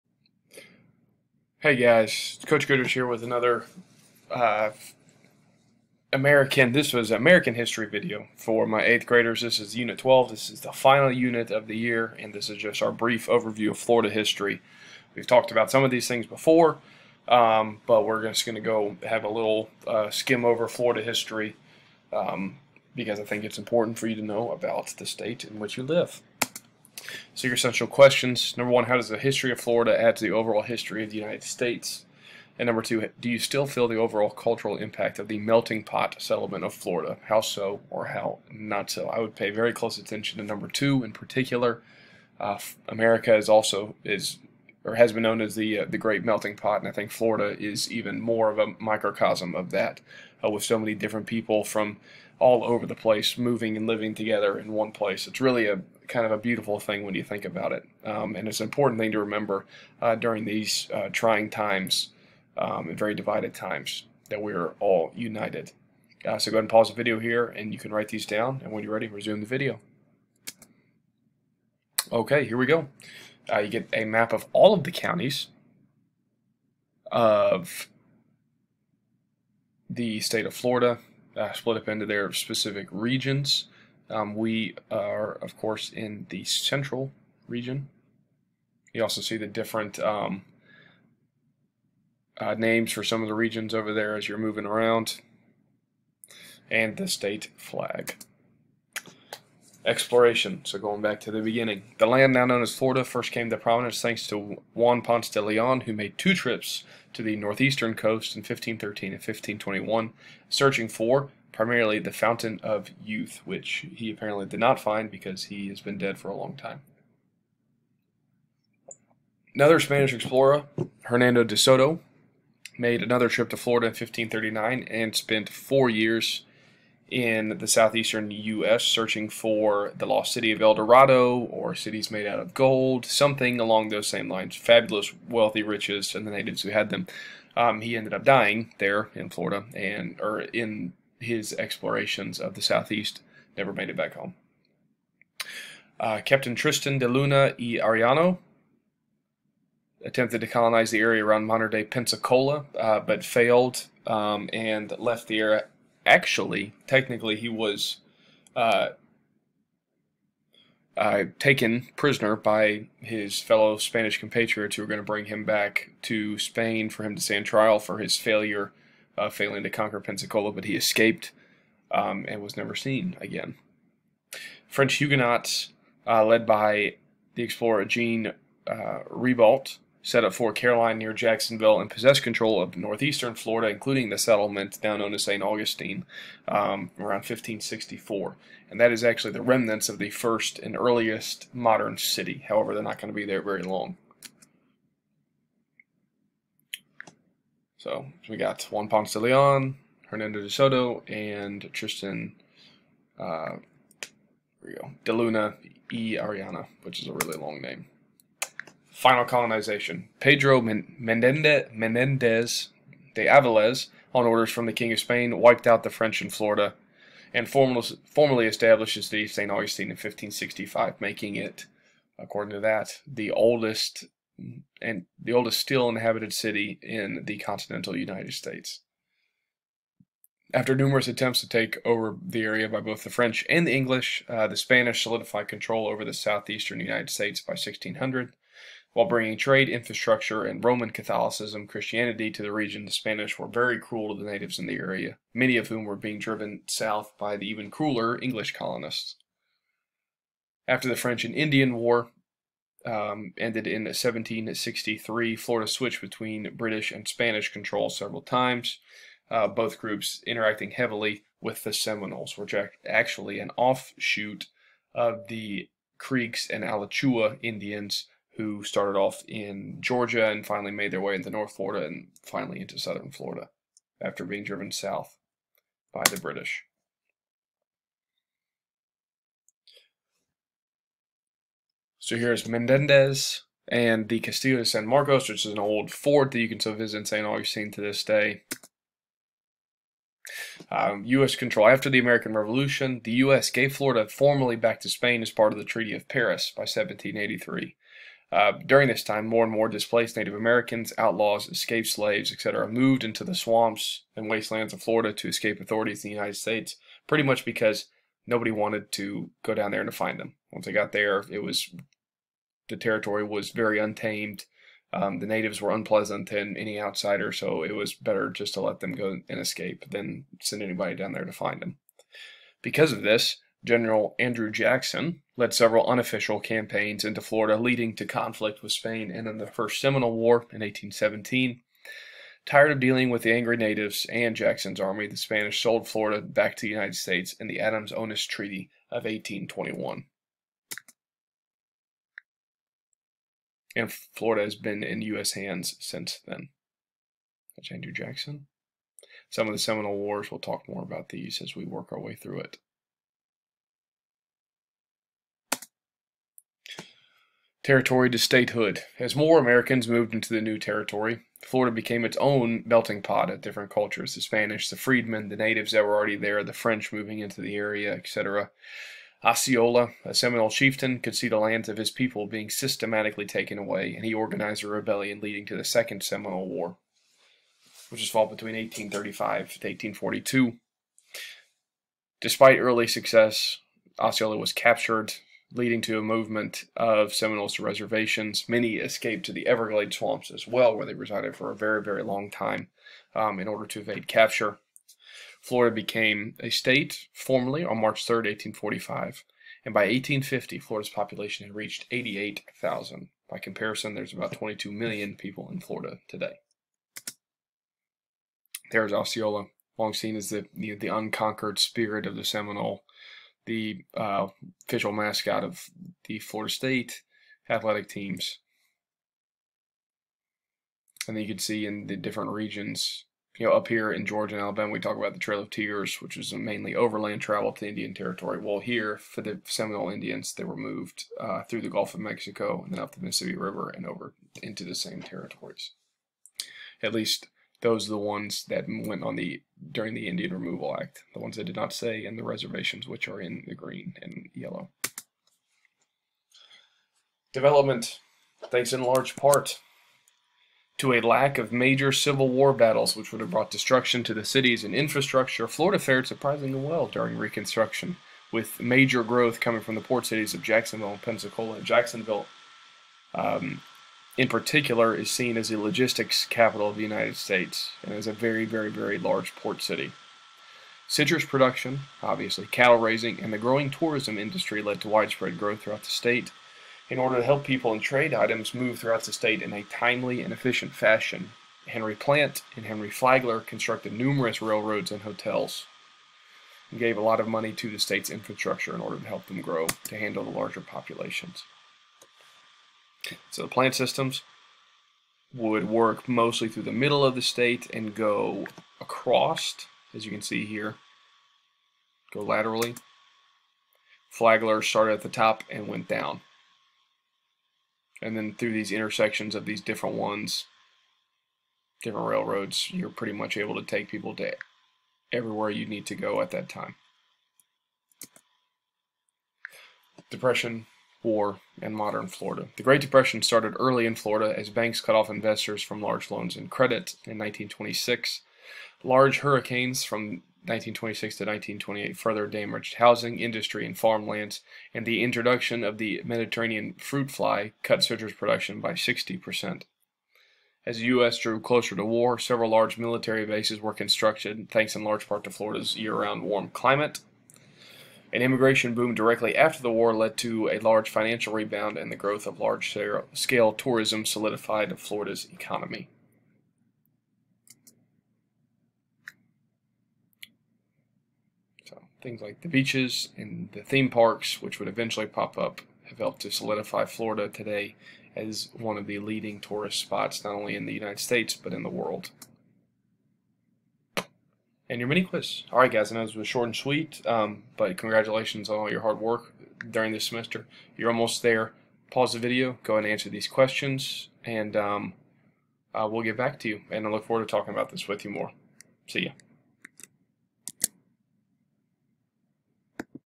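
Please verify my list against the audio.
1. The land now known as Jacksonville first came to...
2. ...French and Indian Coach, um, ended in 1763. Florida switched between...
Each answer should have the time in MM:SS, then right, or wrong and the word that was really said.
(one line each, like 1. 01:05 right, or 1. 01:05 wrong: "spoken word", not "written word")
1. 01:41 wrong: "Florida", not "Jacksonville"
2. 04:10 wrong: "War", not "Coach".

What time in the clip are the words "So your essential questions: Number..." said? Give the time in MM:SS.
00:27.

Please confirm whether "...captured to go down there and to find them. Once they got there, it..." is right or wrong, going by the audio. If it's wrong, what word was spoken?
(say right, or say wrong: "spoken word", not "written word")
wrong: "wanted", not "captured".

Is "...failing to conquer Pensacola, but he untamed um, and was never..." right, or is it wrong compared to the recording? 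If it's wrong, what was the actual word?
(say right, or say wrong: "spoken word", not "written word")
wrong: "escaped", not "untamed".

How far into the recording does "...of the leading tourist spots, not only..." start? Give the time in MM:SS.
09:28.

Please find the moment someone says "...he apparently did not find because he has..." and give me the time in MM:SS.
01:53.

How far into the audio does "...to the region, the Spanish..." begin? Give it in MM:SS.
04:02.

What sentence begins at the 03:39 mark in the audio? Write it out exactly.
Augustine in 1565, making it, according to that, the oldest and the oldest still inhabited city in the continental United States.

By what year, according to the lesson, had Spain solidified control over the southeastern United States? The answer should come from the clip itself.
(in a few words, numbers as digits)
1600.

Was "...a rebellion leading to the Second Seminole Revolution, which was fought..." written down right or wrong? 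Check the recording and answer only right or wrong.
wrong.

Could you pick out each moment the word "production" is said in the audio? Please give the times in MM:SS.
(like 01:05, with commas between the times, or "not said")
07:51, 08:58.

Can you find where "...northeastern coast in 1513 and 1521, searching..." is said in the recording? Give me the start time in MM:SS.
01:47.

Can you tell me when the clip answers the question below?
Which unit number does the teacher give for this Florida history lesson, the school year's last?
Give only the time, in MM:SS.
00:09.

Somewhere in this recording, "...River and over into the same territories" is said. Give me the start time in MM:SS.
07:13.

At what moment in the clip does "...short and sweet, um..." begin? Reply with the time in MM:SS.
09:36.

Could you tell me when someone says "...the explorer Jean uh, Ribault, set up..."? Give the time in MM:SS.
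02:57.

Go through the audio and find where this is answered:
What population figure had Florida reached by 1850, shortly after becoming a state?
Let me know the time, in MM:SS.
06:41.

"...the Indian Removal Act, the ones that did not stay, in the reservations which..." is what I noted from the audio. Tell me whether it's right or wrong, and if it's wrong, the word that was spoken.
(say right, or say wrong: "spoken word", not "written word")
right.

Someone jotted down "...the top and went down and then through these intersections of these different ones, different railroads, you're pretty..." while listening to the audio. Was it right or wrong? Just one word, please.
right.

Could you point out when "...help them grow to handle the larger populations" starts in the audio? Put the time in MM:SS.
08:09.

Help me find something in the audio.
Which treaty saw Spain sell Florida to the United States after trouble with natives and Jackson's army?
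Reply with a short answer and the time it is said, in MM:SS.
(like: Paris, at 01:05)
Adams-Onis Treaty, at 05:37.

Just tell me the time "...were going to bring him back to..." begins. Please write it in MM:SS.
02:44.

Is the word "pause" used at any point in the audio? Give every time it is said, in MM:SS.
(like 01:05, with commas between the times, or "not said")
01:06, 09:41.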